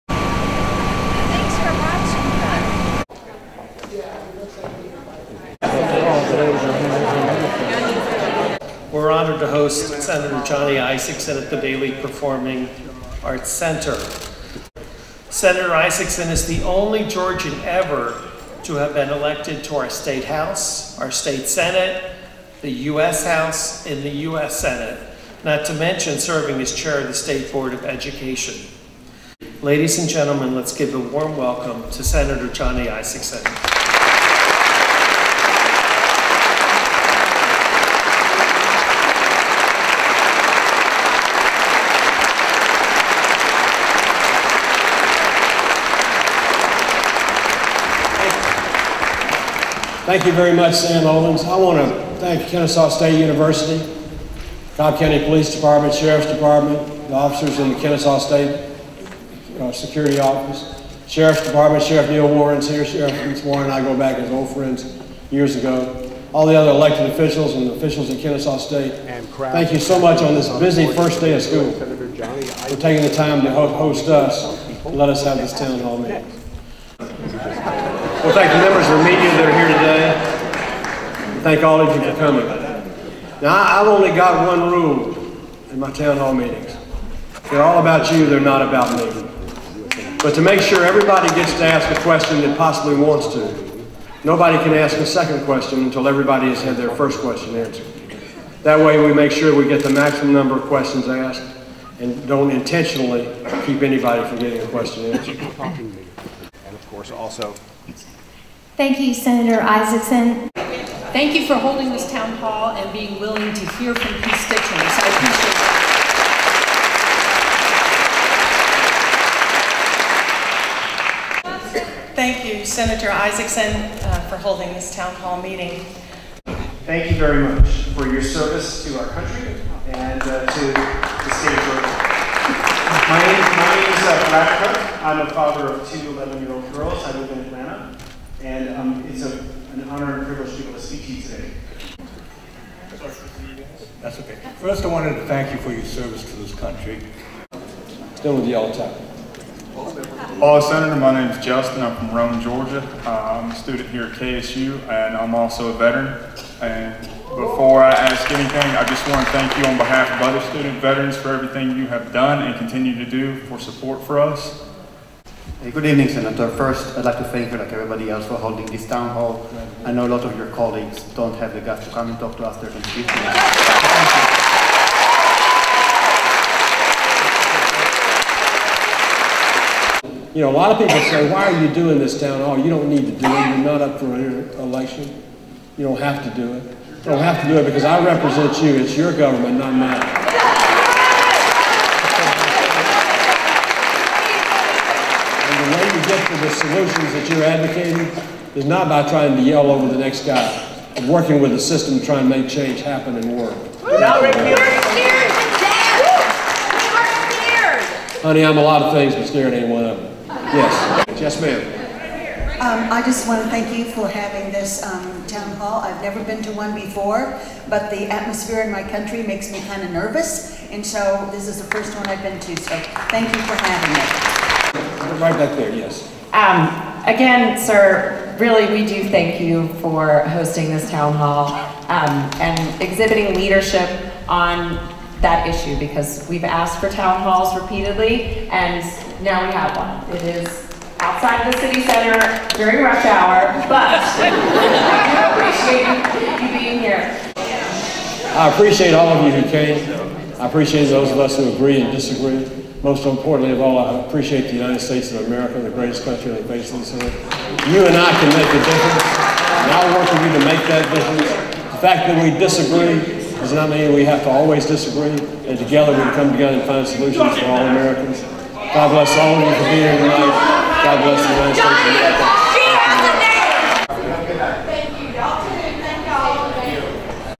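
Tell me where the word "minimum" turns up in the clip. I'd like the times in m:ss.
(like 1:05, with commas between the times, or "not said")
not said.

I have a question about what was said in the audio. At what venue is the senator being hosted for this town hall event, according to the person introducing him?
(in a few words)
Bailey Performing Arts Center.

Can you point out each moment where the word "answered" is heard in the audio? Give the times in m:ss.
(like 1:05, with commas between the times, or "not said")
1:37, 1:45.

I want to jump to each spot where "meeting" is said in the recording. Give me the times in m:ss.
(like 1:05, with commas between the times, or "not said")
1:15, 1:26, 2:05.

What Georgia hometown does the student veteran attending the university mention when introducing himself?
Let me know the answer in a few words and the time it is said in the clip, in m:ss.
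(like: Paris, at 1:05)
Rome, Georgia, at 2:32.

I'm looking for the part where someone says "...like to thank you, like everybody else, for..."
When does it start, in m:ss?
2:47.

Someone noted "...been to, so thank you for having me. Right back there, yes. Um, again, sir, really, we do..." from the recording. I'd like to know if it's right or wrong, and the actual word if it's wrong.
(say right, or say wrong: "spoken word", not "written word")
right.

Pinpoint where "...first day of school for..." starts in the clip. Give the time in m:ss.
1:10.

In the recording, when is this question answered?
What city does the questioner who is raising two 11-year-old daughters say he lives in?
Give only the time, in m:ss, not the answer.
2:17.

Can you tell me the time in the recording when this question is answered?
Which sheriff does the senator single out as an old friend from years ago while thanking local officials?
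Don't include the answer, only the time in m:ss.
1:02.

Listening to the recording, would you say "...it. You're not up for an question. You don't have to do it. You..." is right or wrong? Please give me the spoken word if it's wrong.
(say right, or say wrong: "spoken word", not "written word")
wrong: "election", not "question".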